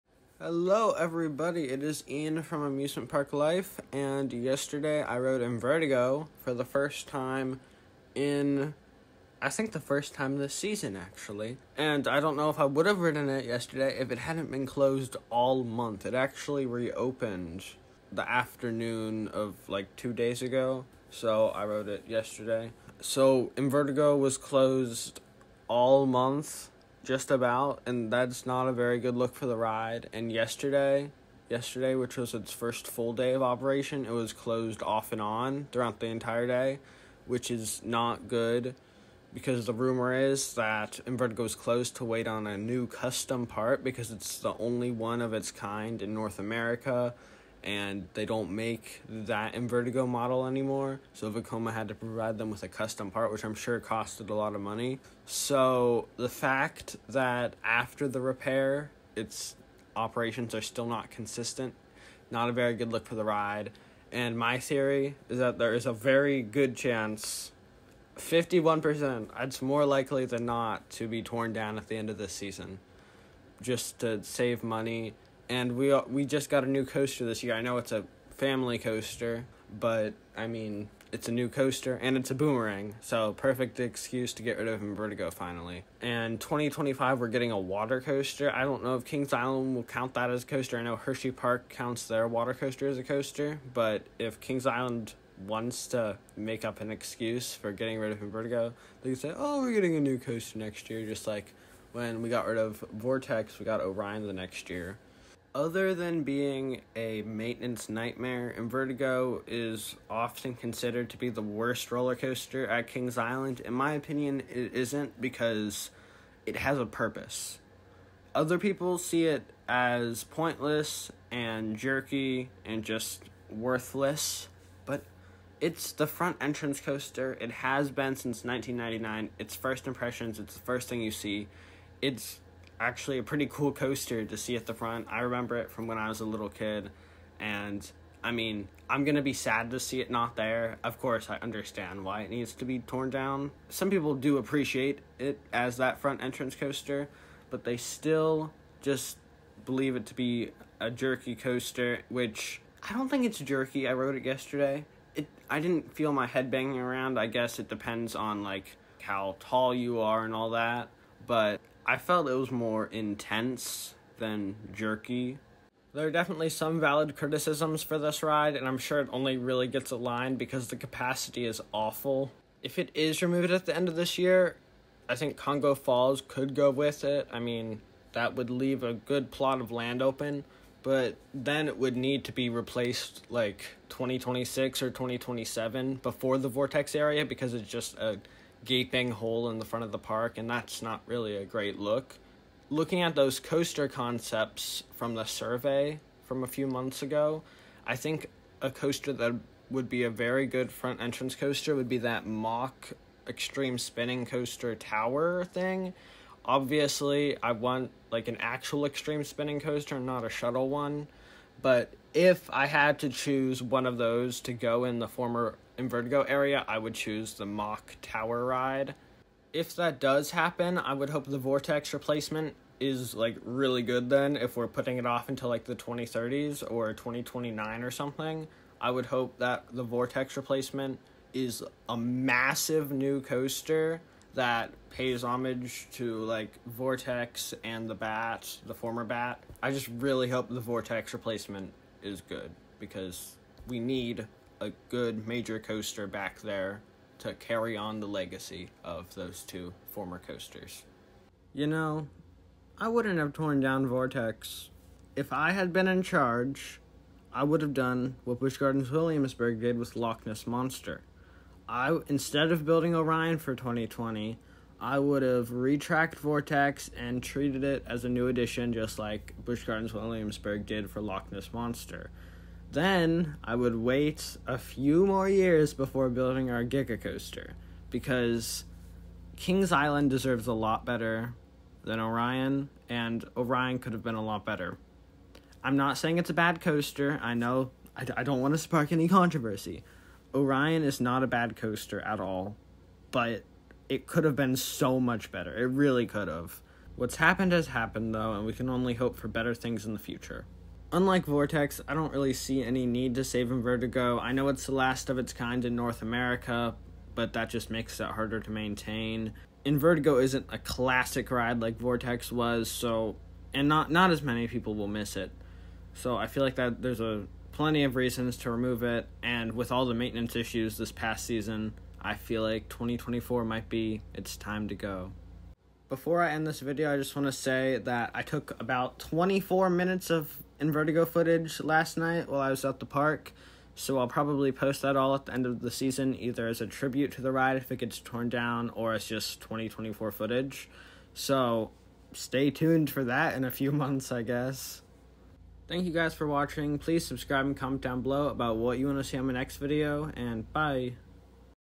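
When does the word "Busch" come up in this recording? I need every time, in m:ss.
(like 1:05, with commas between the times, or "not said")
4:18, 4:29.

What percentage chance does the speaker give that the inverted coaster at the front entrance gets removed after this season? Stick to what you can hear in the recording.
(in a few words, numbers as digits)
51%.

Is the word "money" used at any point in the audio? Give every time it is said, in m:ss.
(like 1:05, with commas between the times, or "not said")
0:54, 1:14.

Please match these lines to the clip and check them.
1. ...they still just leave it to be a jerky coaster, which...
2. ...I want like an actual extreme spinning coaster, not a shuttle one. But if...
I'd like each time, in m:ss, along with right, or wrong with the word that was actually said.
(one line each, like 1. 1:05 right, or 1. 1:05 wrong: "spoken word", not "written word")
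1. 2:27 wrong: "believe", not "leave"
2. 3:27 right.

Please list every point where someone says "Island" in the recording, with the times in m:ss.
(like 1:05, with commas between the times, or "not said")
1:29, 1:34, 1:53, 4:39.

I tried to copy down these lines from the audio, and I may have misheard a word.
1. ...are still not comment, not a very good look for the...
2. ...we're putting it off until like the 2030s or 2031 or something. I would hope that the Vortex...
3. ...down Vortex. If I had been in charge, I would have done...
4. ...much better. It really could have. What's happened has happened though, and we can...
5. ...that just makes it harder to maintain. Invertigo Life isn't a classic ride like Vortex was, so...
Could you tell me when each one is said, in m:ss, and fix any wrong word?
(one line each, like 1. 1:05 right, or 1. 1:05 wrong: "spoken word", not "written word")
1. 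1:00 wrong: "consistent", not "comment"
2. 3:44 wrong: "2029", not "2031"
3. 4:13 right
4. 4:54 right
5. 5:07 wrong: "Vertigo", not "Life".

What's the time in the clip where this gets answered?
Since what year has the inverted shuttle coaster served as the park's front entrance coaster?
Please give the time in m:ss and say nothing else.
2:08.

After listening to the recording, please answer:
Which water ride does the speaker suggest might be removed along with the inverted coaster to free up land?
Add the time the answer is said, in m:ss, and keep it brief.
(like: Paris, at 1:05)
Congo Falls, at 2:55.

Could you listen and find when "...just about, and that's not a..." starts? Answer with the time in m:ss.
0:27.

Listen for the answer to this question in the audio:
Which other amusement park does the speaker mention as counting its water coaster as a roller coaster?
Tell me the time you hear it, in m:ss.
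1:30.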